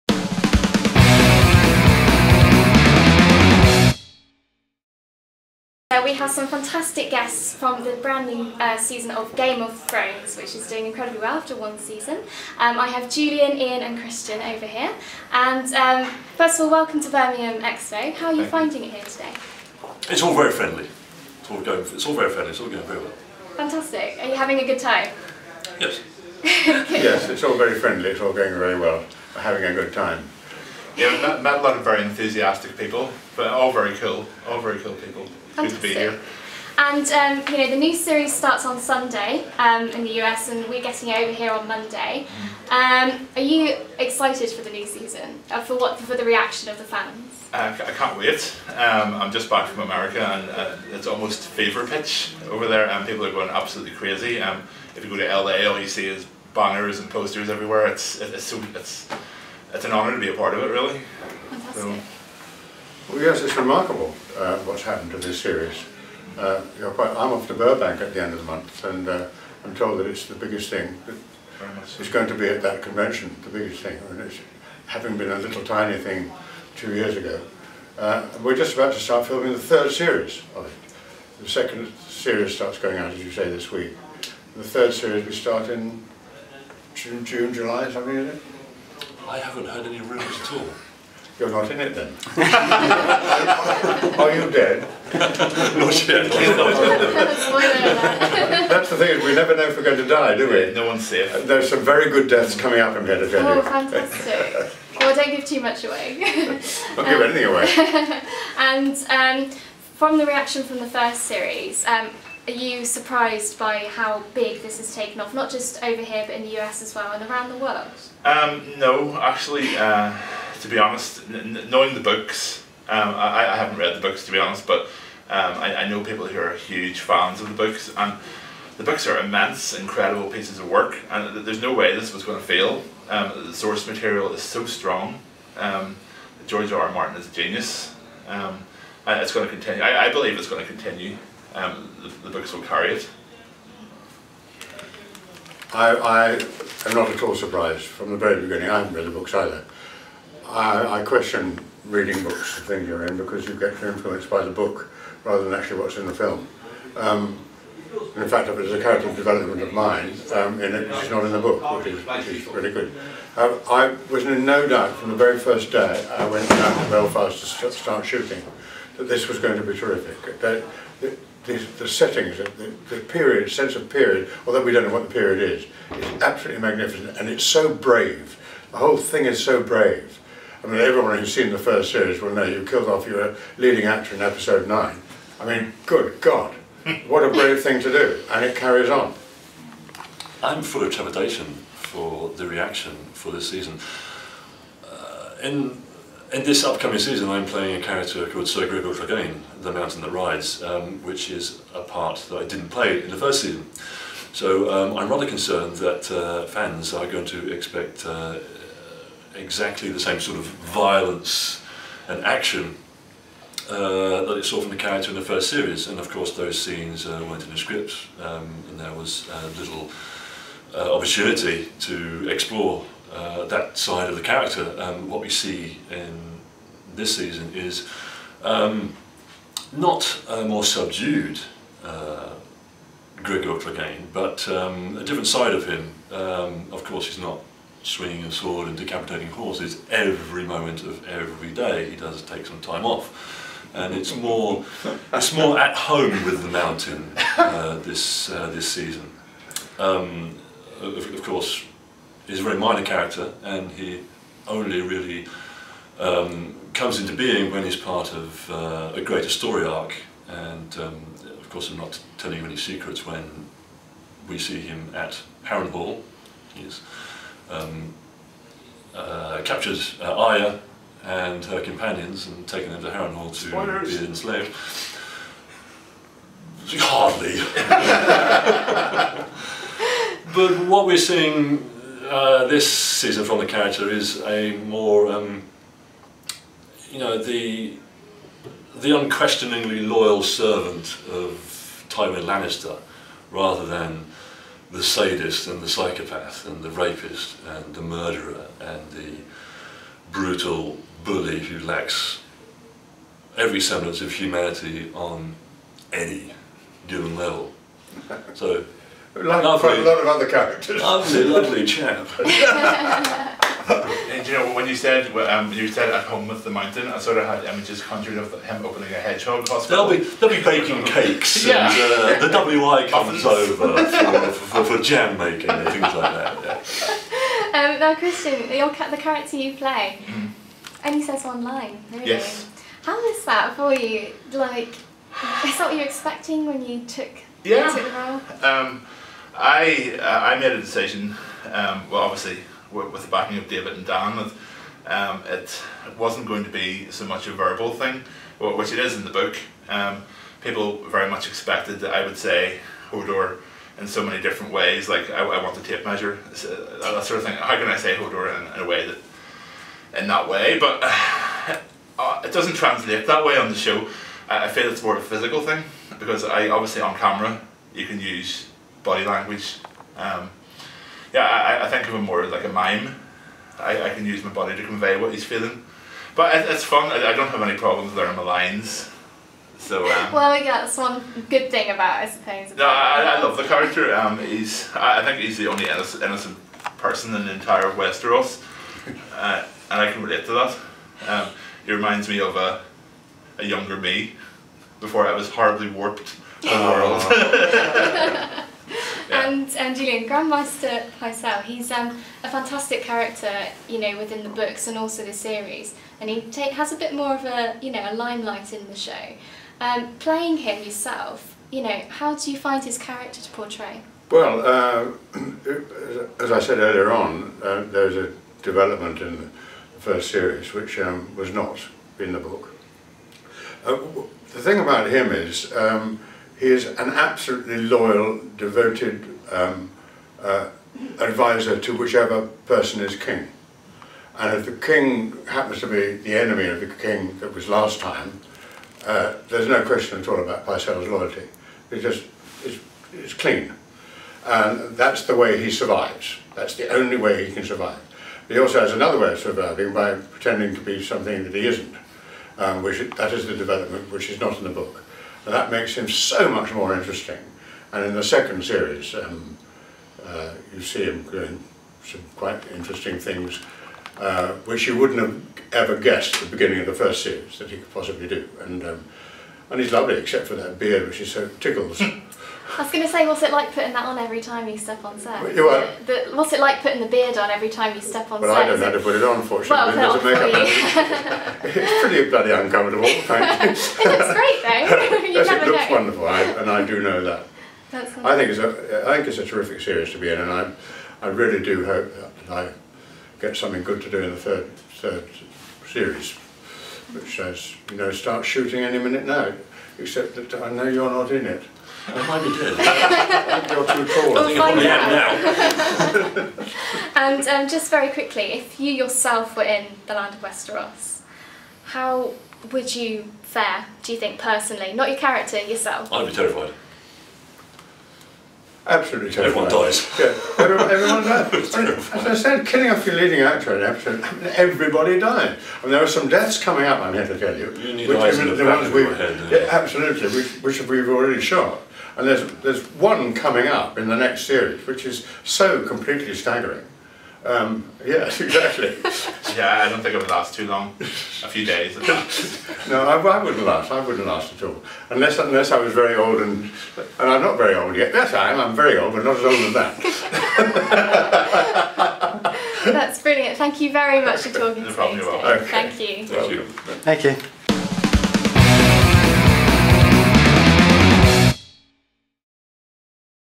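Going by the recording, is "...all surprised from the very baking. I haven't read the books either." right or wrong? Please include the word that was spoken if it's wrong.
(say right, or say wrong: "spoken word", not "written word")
wrong: "beginning", not "baking".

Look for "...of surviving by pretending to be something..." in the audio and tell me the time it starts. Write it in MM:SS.
07:29.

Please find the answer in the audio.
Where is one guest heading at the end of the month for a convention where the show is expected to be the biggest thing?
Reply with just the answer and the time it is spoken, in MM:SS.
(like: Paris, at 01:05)
Burbank, at 01:07.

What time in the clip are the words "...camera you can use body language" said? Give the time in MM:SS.
06:06.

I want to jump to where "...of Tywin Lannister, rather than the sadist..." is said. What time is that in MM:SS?
04:51.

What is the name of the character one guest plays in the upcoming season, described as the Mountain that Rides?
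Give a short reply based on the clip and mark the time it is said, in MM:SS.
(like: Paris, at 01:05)
Sir Gregor Clegane, at 03:18.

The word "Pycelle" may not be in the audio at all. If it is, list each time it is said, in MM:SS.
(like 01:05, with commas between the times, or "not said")
06:40, 07:20.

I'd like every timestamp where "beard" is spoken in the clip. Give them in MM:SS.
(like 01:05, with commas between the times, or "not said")
07:50, 07:56.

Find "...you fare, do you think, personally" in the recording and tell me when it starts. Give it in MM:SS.
08:32.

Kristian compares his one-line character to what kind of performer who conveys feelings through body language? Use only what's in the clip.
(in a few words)
A mime.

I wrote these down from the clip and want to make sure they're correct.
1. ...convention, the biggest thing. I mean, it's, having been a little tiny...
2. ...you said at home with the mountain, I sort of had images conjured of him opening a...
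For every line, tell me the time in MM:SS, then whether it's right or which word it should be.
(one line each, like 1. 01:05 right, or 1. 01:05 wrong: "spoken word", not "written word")
1. 01:12 right
2. 05:15 right.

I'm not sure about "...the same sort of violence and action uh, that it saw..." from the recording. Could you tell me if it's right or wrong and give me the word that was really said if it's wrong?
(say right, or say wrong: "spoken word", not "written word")
right.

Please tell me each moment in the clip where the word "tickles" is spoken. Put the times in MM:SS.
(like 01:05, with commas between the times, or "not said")
07:51.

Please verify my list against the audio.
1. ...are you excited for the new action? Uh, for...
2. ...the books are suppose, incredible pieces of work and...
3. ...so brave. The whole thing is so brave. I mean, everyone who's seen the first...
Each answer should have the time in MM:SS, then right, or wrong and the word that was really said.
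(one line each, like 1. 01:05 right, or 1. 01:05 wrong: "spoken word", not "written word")
1. 00:43 wrong: "season", not "action"
2. 02:08 wrong: "immense", not "suppose"
3. 02:57 right.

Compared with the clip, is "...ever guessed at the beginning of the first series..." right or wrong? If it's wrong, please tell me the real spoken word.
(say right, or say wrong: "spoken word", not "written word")
right.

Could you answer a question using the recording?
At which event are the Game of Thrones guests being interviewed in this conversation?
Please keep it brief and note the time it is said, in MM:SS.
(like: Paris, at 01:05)
Birmingham Expo, at 00:17.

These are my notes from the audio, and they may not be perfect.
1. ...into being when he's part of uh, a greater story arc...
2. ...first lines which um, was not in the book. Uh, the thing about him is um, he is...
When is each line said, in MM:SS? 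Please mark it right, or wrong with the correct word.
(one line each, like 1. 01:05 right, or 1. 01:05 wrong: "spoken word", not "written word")
1. 04:16 right
2. 06:59 wrong: "series", not "lines".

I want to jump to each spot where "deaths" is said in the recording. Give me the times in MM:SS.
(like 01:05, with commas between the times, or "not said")
01:42, 08:46.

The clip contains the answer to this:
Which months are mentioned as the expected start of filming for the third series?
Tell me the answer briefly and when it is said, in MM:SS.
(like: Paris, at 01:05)
June July, at 01:27.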